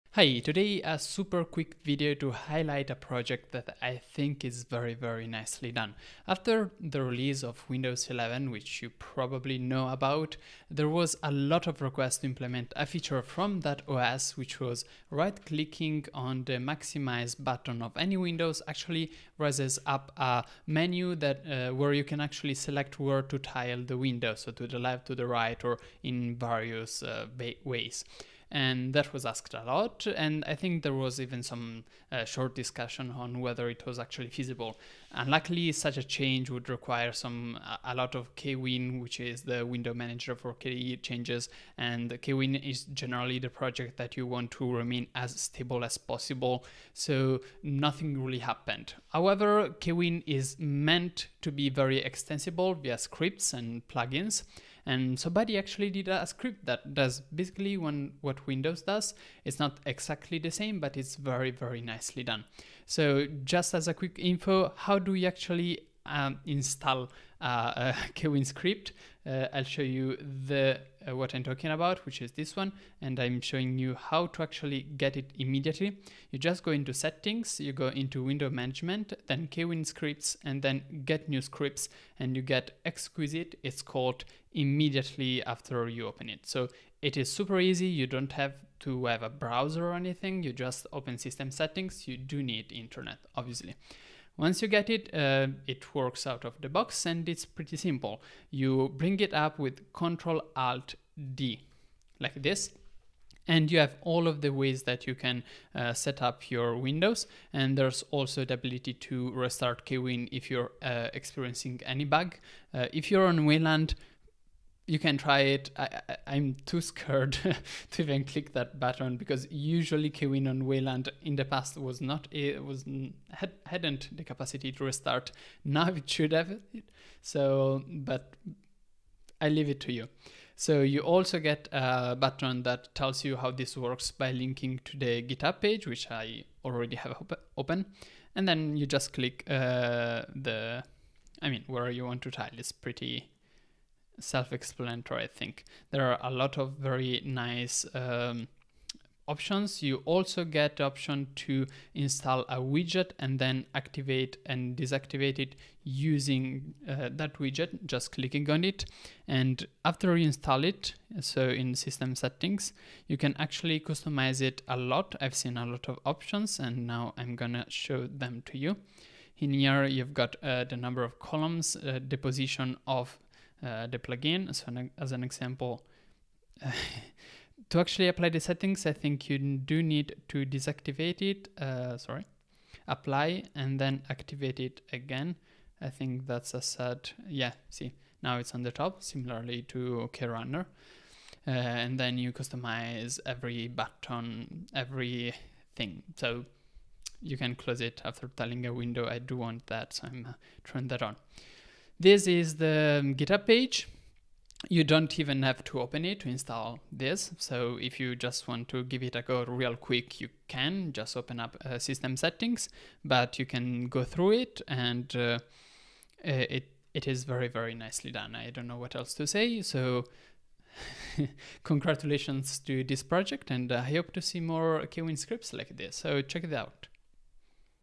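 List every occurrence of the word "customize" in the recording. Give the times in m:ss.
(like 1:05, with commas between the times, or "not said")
2:43, 3:12.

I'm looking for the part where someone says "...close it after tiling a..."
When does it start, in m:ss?
3:17.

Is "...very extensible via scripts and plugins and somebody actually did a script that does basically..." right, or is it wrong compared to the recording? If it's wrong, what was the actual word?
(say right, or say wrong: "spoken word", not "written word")
right.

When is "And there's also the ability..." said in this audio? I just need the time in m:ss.
1:47.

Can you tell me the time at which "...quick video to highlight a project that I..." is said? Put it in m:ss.
0:01.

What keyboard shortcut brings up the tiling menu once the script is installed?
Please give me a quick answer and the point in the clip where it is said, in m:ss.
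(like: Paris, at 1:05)
Ctrl Alt D, at 1:39.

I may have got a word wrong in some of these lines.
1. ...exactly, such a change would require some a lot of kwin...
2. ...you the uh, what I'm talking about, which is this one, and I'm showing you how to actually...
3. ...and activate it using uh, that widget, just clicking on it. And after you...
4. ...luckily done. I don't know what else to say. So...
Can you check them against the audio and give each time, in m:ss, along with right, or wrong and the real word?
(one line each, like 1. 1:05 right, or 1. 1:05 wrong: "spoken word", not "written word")
1. 0:35 wrong: "luckily", not "exactly"
2. 1:09 right
3. 2:34 wrong: "deactivate", not "activate"
4. 3:37 wrong: "nicely", not "luckily".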